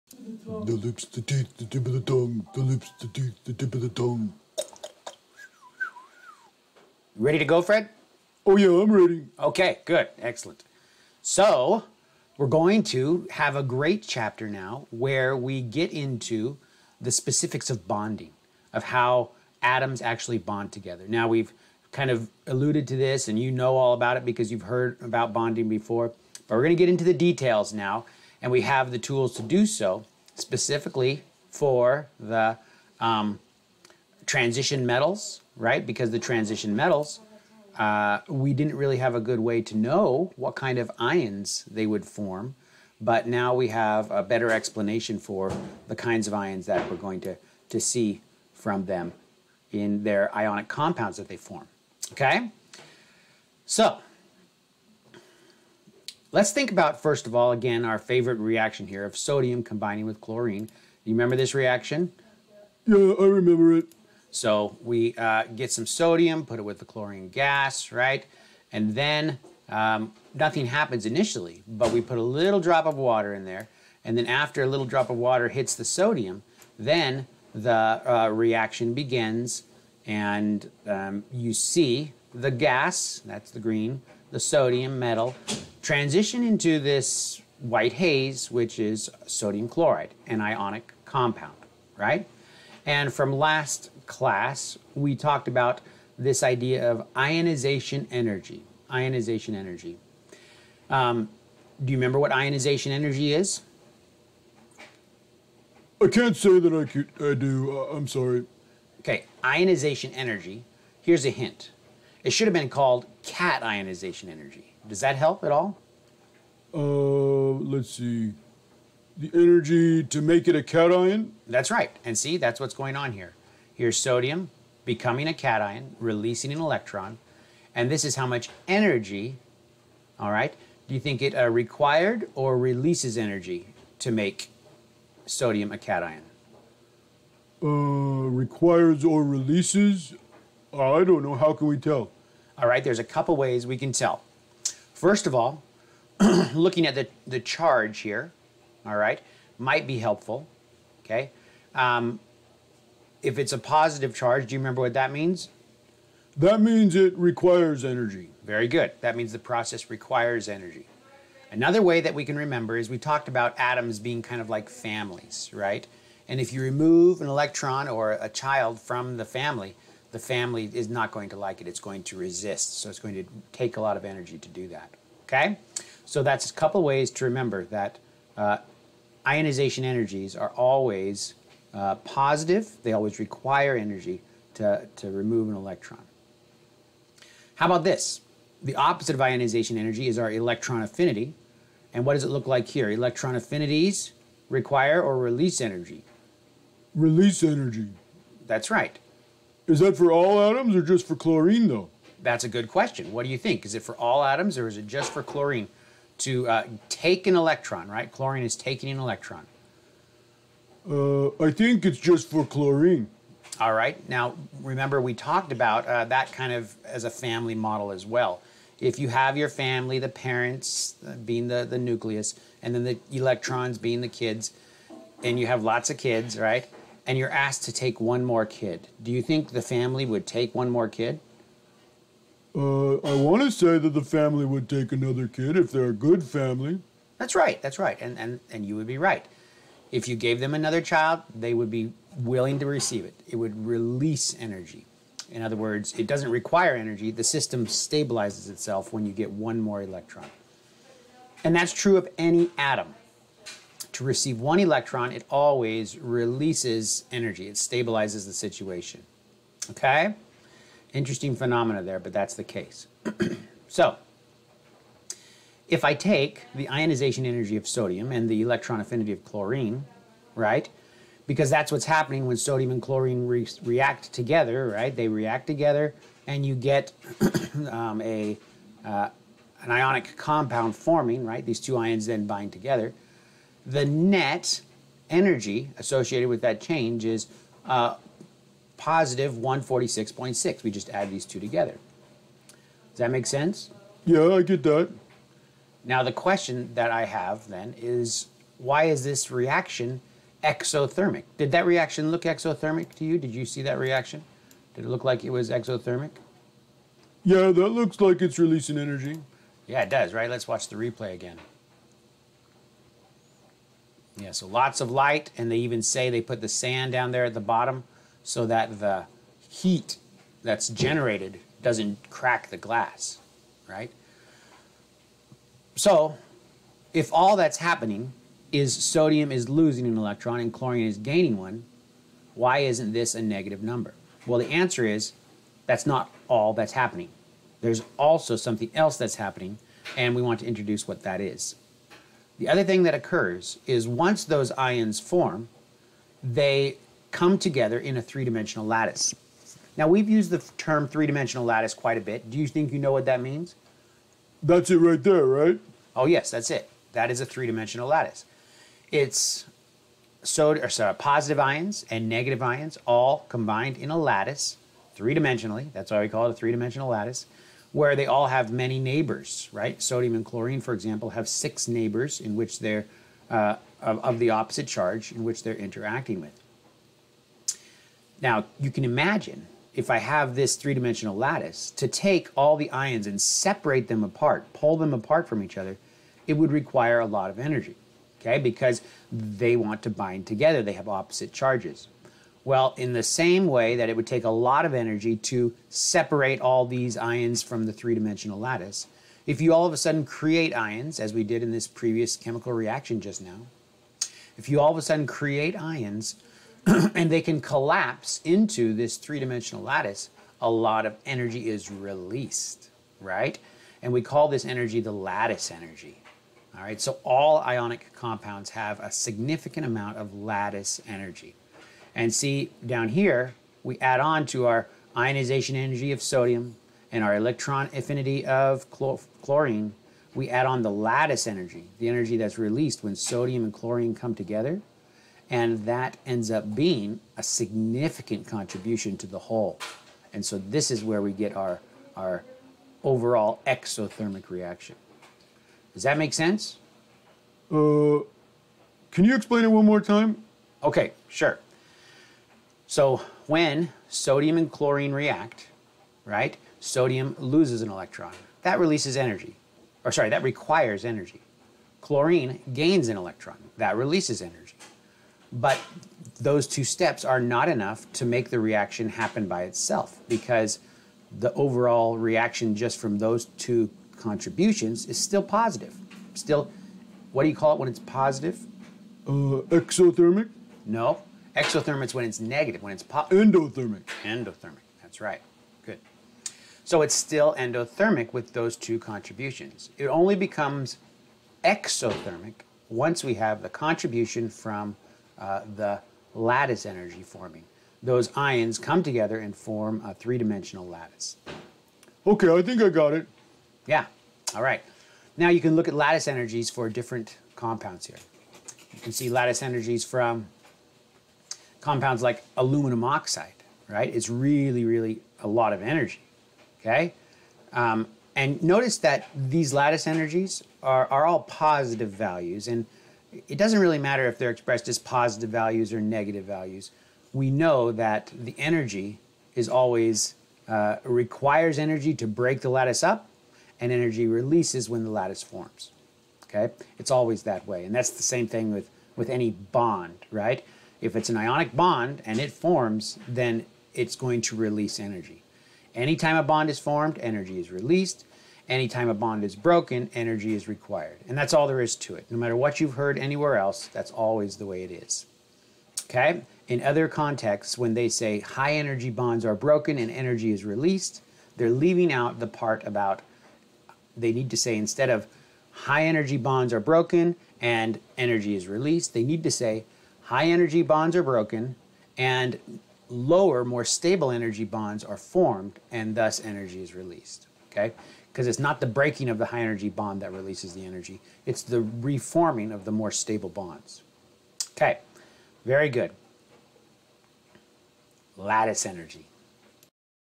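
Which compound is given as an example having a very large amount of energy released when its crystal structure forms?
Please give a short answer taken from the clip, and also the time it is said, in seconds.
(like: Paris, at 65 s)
aluminum oxide, at 512 s.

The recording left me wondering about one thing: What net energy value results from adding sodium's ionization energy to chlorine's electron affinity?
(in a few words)
146.6.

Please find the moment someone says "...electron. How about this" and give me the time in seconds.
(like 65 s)
185 s.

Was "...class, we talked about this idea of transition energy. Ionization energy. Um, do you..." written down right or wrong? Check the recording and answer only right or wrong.
wrong.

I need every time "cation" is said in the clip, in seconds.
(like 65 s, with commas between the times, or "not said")
120 s, 125 s, 135 s.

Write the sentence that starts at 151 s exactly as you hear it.
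Um, if it's a positive charge, do you remember what that means?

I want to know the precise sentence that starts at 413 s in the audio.
And we call this energy the lattice energy.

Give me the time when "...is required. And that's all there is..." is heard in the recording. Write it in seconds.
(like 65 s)
550 s.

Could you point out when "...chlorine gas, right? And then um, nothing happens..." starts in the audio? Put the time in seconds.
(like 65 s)
66 s.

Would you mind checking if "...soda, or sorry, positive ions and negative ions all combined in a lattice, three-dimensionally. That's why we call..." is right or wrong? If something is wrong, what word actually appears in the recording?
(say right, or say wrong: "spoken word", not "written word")
right.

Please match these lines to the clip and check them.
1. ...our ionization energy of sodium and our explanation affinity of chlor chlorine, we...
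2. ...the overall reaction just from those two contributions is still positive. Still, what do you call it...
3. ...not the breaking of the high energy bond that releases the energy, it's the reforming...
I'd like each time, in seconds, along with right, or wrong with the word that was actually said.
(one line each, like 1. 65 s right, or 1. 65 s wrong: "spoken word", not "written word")
1. 424 s wrong: "electron", not "explanation"
2. 471 s right
3. 578 s right.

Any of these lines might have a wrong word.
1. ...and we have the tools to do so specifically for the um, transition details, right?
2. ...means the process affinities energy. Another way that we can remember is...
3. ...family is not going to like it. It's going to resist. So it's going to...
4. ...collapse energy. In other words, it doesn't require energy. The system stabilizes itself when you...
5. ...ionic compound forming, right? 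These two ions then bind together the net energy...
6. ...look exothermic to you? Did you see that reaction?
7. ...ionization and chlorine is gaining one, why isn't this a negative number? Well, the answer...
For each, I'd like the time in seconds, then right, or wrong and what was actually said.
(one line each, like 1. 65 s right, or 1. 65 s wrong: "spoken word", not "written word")
1. 28 s wrong: "metals", not "details"
2. 159 s wrong: "requires", not "affinities"
3. 170 s right
4. 243 s wrong: "release", not "collapse"
5. 279 s right
6. 302 s right
7. 329 s wrong: "electron", not "ionization".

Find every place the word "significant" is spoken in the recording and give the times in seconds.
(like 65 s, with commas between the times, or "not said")
418 s, 437 s.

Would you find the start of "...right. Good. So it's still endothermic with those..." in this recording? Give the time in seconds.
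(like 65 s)
484 s.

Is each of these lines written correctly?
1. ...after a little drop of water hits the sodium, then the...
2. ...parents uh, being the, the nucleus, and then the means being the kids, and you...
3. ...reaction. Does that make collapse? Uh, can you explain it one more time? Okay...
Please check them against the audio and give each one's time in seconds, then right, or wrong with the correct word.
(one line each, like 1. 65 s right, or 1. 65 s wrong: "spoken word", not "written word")
1. 74 s right
2. 220 s wrong: "electrons", not "means"
3. 444 s wrong: "sense", not "collapse".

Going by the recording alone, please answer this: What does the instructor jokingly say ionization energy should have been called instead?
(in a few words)
cat ionization energy.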